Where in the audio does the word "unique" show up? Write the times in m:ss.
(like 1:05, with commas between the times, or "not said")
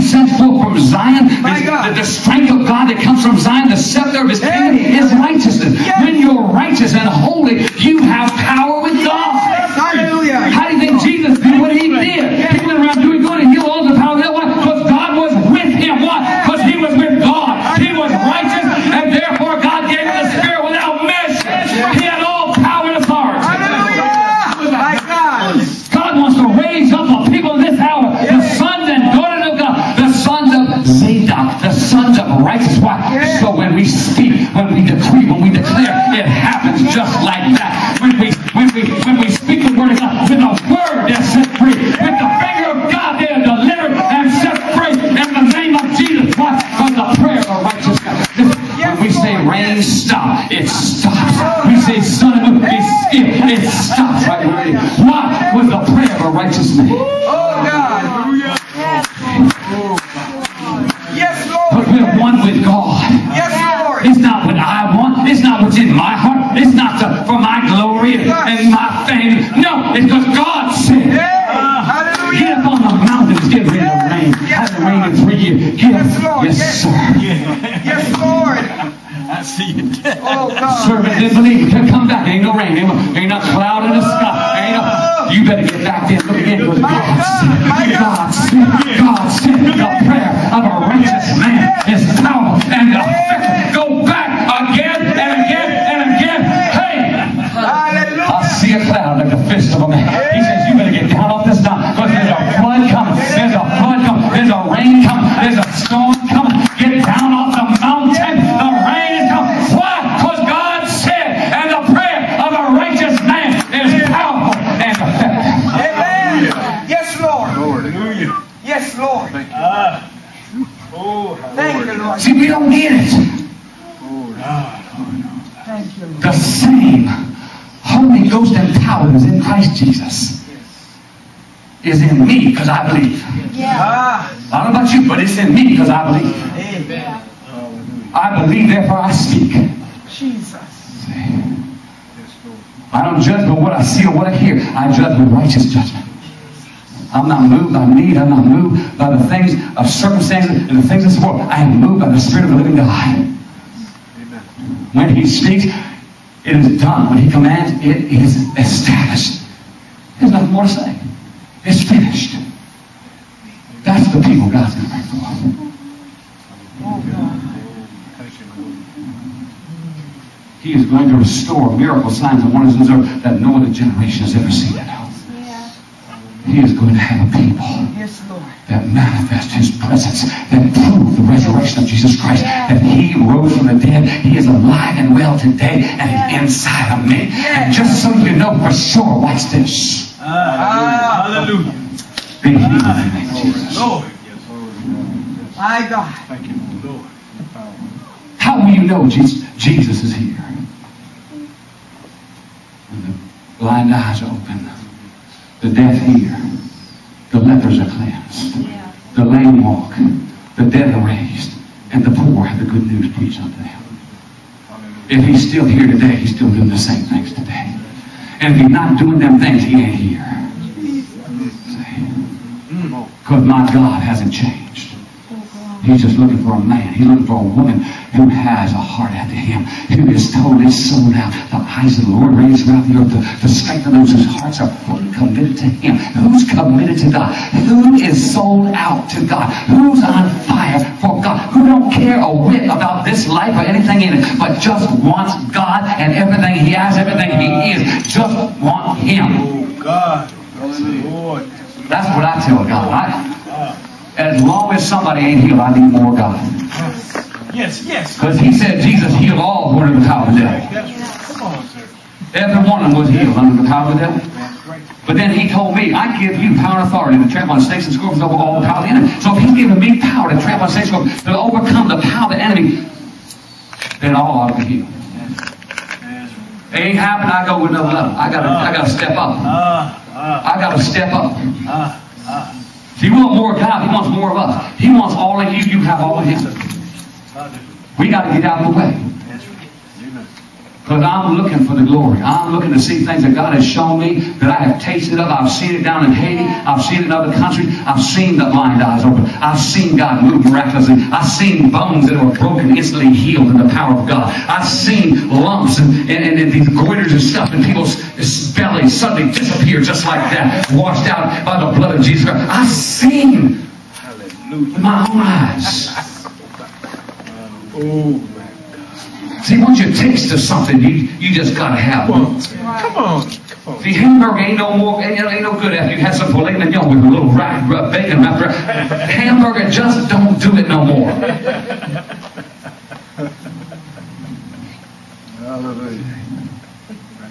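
not said.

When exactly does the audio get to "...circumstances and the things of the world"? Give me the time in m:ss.
2:29.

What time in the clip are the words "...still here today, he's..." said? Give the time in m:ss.
3:35.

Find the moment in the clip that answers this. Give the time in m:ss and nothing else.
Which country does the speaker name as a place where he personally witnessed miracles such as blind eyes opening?
4:56.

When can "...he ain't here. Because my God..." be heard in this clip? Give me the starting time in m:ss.
3:39.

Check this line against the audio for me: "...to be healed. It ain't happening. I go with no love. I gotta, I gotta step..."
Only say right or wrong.
right.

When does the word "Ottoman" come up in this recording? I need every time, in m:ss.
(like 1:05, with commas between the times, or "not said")
not said.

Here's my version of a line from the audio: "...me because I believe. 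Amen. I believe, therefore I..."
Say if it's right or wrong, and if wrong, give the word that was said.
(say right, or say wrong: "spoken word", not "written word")
right.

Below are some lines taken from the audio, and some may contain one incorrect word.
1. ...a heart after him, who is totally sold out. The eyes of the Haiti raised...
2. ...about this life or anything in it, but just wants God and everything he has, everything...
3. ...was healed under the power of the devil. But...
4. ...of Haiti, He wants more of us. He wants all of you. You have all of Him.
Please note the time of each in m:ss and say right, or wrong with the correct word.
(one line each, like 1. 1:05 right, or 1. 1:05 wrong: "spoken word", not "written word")
1. 3:48 wrong: "Lord", not "Haiti"
2. 4:02 right
3. 4:22 right
4. 4:43 wrong: "God", not "Haiti".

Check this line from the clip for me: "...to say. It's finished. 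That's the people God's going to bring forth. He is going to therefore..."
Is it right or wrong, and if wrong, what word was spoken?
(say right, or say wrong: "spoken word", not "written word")
wrong: "restore", not "therefore".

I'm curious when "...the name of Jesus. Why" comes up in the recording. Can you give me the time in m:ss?
0:45.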